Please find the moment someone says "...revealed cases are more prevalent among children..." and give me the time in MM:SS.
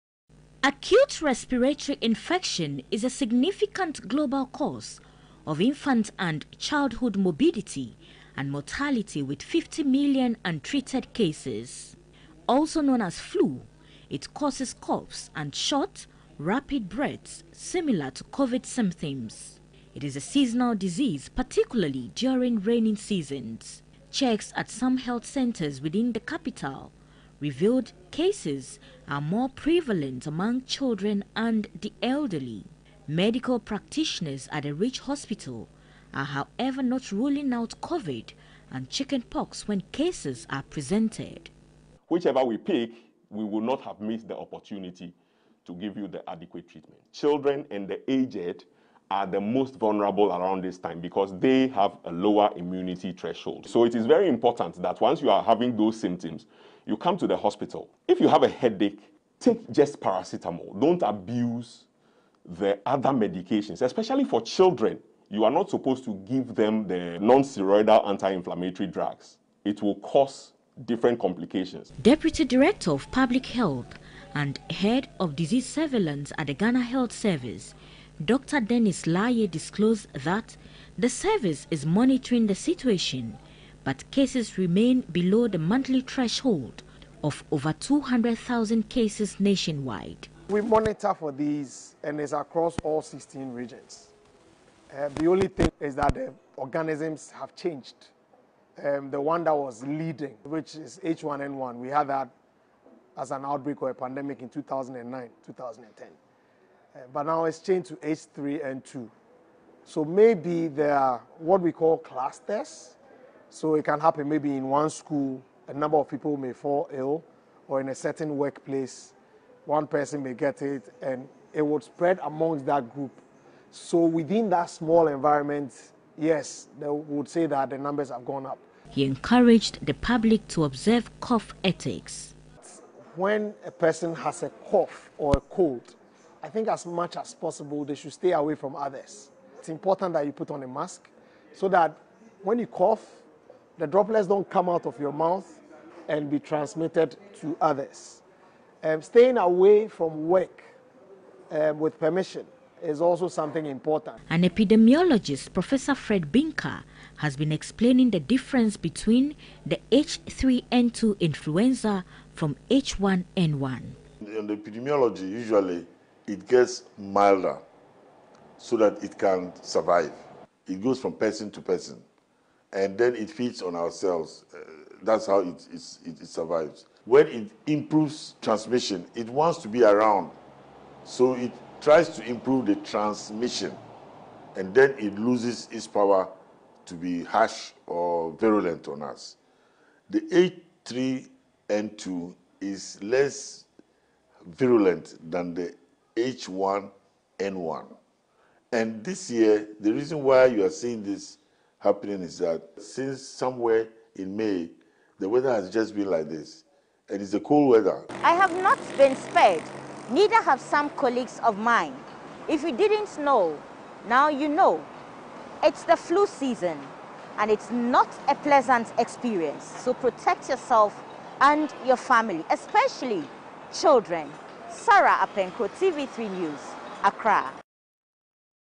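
00:27.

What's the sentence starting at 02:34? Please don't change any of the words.
An epidemiologist, Professor Fred Binka, has been explaining the difference between the H3N2 influenza from H1N1.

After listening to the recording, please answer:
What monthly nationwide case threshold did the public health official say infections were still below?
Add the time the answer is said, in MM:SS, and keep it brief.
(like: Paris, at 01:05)
200,000, at 01:27.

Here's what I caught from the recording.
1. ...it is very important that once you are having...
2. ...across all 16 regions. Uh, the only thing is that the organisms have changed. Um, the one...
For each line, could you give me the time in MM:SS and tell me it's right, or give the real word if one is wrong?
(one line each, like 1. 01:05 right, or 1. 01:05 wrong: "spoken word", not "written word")
1. 00:53 right
2. 01:32 right.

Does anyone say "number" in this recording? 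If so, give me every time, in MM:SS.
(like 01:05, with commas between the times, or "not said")
01:55, 02:07.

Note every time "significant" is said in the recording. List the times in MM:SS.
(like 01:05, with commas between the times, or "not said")
00:03.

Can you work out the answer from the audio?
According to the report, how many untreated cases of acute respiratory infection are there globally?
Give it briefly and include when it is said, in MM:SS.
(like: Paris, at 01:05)
50 million, at 00:09.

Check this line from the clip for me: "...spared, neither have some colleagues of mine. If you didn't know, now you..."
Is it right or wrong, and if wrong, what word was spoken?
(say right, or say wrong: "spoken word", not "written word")
right.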